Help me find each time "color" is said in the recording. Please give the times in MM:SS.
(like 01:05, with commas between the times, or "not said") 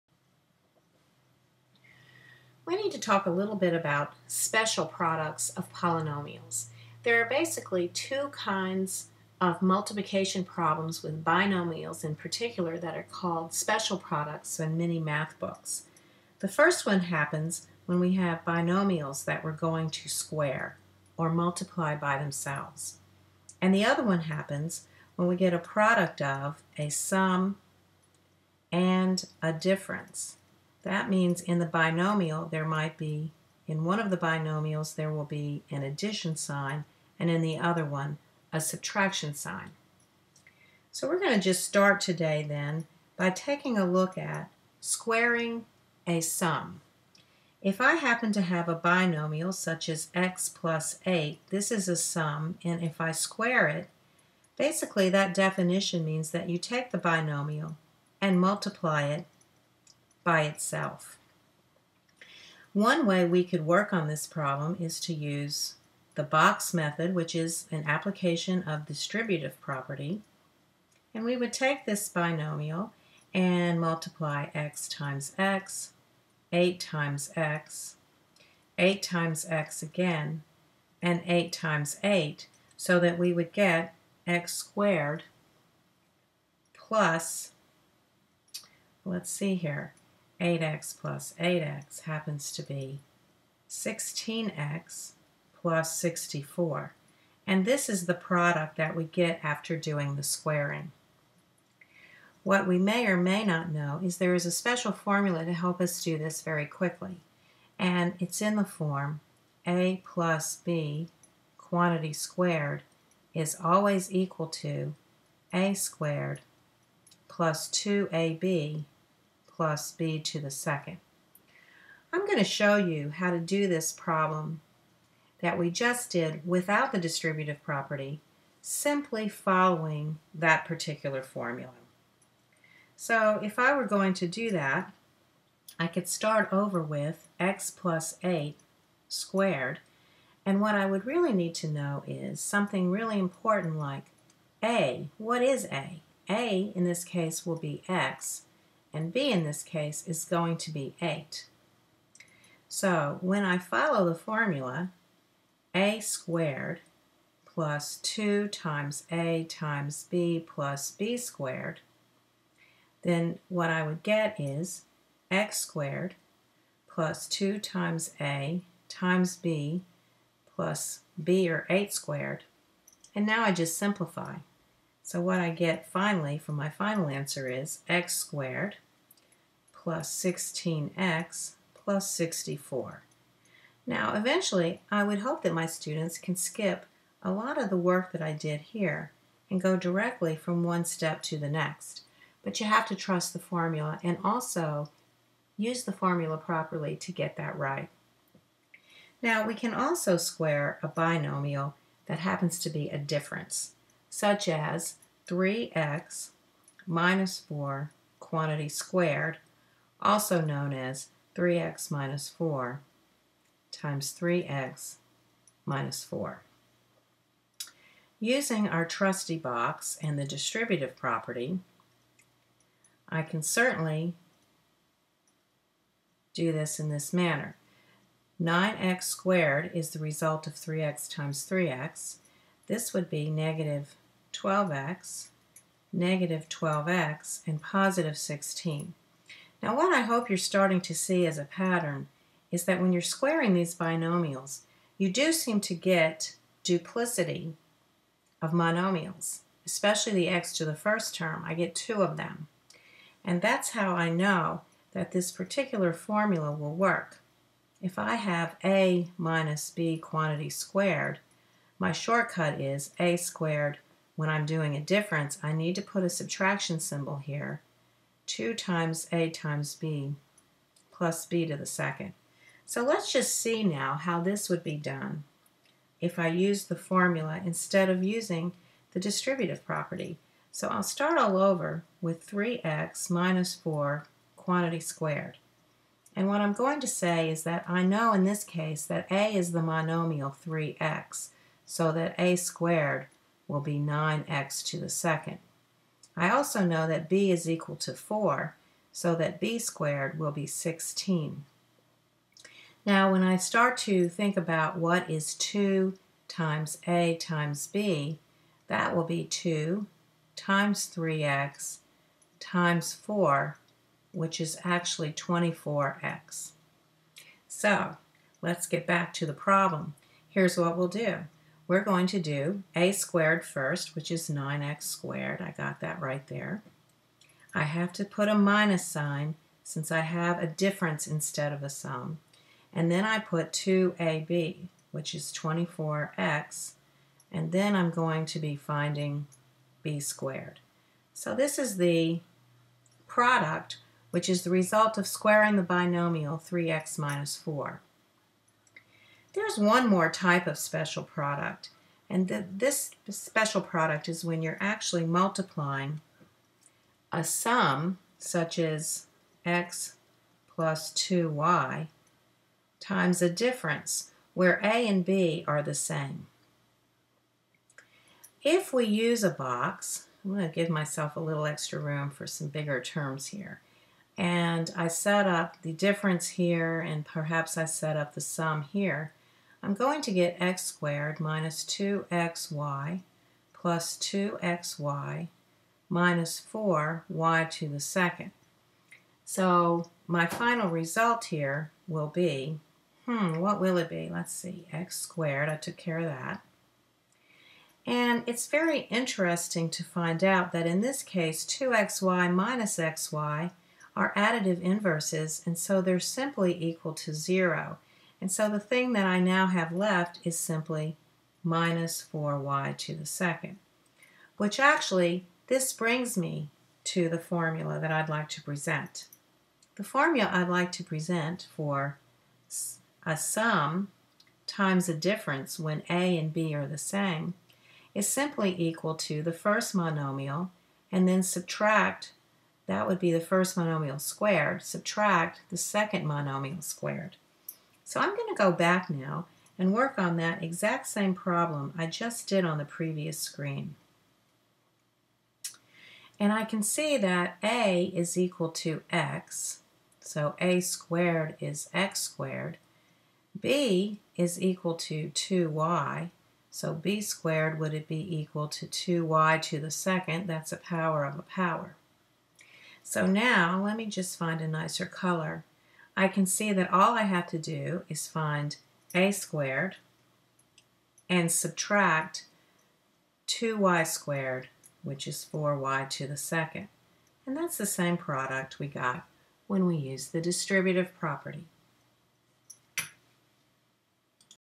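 07:44.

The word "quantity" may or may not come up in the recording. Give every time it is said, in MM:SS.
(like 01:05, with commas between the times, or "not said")
01:51, 03:28, 04:19, 04:44.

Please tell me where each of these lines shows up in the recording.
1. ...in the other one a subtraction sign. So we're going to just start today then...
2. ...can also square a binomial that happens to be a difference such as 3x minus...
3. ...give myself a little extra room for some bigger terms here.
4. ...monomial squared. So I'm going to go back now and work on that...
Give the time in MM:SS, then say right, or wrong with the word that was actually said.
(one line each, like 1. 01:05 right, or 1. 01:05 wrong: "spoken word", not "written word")
1. 00:37 right
2. 03:19 right
3. 06:10 right
4. 07:16 right.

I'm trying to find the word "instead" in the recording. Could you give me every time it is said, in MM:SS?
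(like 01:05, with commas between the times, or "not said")
04:37, 05:31.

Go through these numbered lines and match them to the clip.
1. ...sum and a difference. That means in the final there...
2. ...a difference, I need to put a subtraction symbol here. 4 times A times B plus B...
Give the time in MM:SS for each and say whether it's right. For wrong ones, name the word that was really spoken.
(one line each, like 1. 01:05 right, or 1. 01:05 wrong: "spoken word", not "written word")
1. 00:26 wrong: "binomial", not "final"
2. 04:24 wrong: "2", not "4".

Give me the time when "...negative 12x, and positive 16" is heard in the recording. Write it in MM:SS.
03:55.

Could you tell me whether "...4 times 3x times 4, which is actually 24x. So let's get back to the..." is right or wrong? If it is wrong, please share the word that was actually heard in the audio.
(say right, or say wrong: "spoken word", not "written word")
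wrong: "2", not "4".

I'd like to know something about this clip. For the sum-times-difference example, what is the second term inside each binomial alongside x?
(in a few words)
2y.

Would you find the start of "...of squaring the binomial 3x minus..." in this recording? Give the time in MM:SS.
05:44.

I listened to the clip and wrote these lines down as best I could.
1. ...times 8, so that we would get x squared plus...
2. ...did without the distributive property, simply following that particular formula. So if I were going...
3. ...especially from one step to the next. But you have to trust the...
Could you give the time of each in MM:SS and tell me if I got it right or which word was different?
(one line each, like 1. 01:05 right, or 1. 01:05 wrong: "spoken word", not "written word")
1. 01:21 right
2. 02:06 right
3. 03:09 wrong: "directly", not "especially".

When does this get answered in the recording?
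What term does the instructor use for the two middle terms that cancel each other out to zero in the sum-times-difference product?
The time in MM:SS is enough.
06:44.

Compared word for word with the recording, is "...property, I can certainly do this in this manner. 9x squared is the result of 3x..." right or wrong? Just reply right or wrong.
right.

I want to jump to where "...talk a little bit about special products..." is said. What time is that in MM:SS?
00:02.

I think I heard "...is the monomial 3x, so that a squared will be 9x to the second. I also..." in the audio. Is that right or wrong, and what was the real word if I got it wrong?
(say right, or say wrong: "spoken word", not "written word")
right.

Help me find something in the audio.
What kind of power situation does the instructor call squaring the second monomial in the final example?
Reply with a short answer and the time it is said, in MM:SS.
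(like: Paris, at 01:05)
a power of a power, at 07:40.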